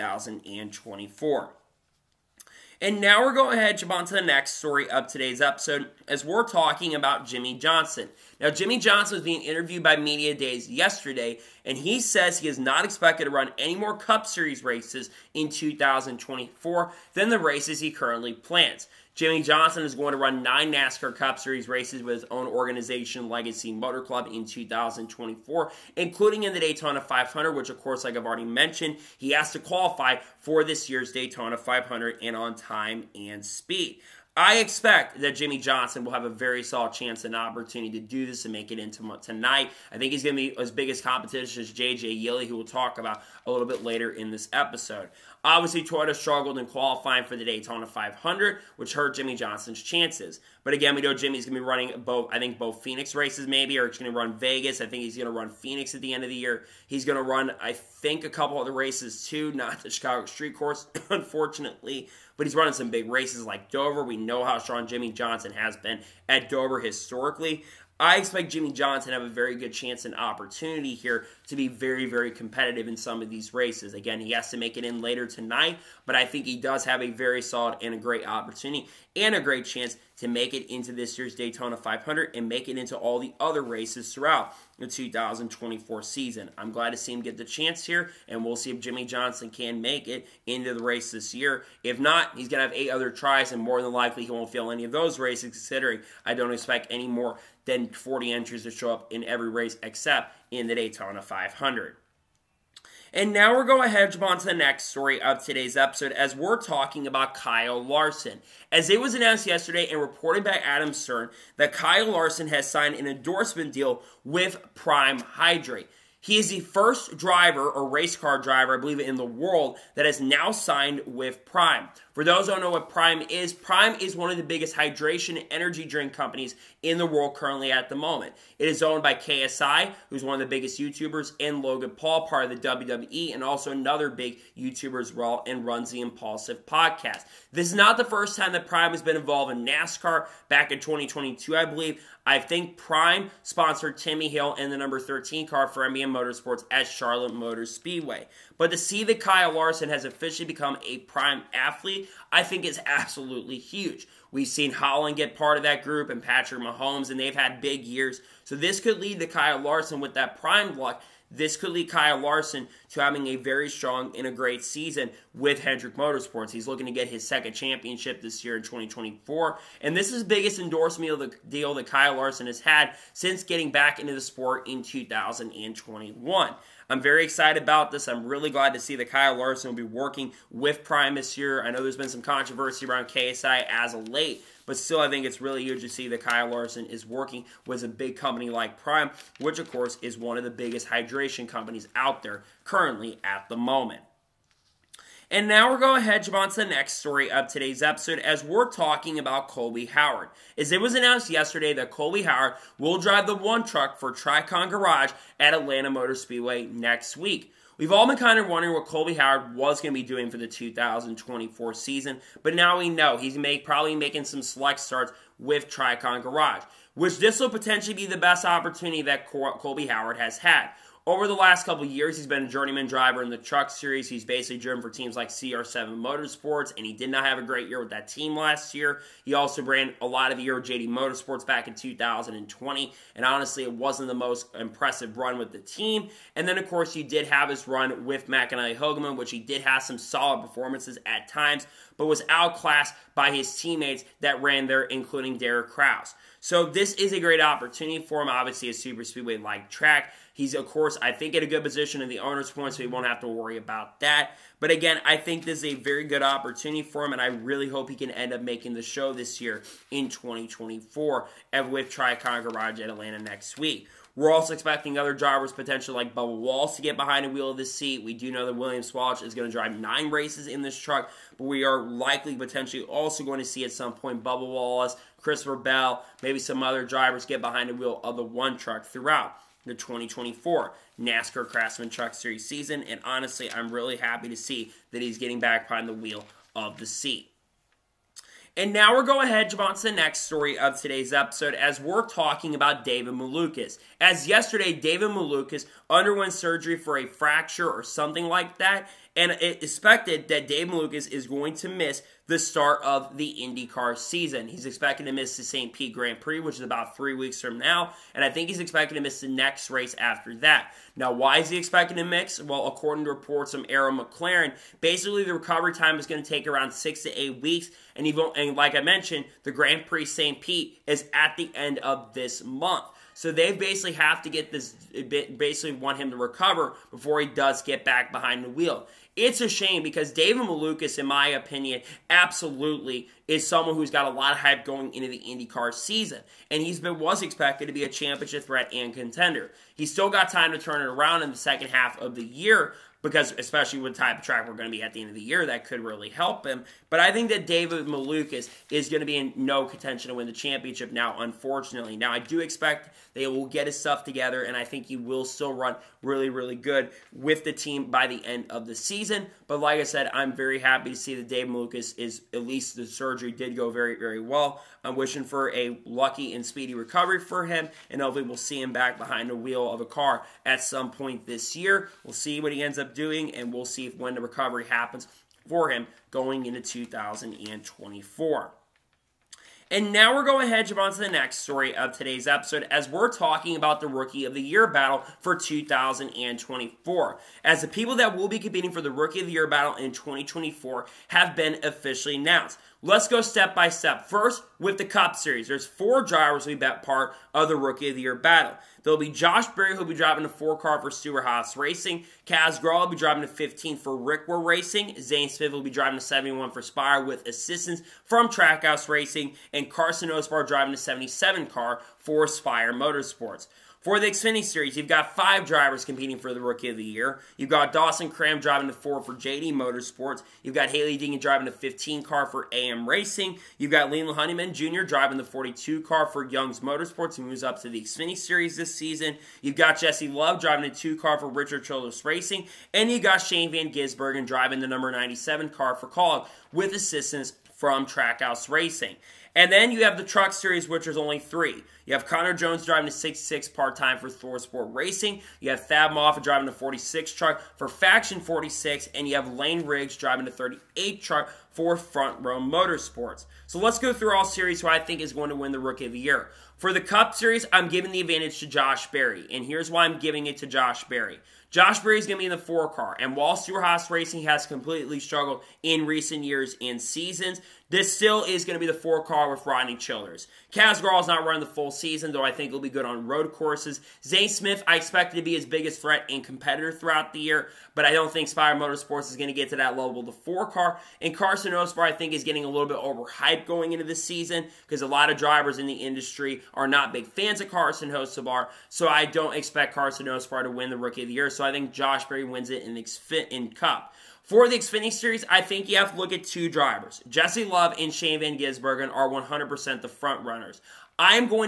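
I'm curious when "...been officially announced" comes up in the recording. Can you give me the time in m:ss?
6:31.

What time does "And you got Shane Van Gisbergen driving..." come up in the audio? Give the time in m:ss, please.
7:12.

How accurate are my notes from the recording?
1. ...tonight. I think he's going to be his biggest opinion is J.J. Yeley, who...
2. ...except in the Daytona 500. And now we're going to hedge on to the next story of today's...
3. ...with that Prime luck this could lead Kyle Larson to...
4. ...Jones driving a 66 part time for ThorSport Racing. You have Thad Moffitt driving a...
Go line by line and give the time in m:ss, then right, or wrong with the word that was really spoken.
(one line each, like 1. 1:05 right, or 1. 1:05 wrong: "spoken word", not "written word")
1. 0:39 wrong: "competition", not "opinion"
2. 1:39 right
3. 2:39 right
4. 7:22 right.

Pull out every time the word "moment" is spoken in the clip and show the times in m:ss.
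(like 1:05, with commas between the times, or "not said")
2:07, 3:13.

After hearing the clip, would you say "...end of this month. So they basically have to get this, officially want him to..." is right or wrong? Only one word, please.
wrong.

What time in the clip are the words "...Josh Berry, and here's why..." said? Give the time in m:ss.
7:38.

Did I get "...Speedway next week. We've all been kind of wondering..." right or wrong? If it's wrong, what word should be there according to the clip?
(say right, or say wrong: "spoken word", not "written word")
right.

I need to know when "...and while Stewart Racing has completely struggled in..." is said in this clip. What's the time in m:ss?
7:43.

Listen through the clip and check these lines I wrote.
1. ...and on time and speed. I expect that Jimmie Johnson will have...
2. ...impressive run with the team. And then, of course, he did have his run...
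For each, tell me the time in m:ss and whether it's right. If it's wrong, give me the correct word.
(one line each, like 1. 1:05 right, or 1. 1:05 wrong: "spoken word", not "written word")
1. 0:32 right
2. 3:54 right.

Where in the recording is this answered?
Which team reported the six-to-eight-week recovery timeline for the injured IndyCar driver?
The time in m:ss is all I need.
5:13.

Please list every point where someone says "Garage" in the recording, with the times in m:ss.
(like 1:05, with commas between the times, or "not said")
3:24, 3:36, 4:22.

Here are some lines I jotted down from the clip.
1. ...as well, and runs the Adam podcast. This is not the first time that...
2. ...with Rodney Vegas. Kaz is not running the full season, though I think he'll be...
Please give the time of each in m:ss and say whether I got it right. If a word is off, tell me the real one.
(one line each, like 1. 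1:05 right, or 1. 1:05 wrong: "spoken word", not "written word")
1. 2:15 wrong: "Impulsive", not "Adam"
2. 7:49 wrong: "Childers", not "Vegas".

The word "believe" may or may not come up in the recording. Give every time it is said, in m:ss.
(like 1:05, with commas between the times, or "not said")
1:58, 2:21.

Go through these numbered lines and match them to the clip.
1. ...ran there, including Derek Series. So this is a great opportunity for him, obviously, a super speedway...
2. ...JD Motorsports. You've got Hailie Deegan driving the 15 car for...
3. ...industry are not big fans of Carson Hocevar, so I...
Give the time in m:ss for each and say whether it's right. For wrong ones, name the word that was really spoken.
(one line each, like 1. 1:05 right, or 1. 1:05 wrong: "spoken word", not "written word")
1. 4:04 wrong: "Kraus", not "Series"
2. 6:59 right
3. 8:05 right.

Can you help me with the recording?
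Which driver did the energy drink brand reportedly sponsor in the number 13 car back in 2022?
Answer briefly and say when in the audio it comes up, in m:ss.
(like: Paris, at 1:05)
Timmy Hill, at 2:23.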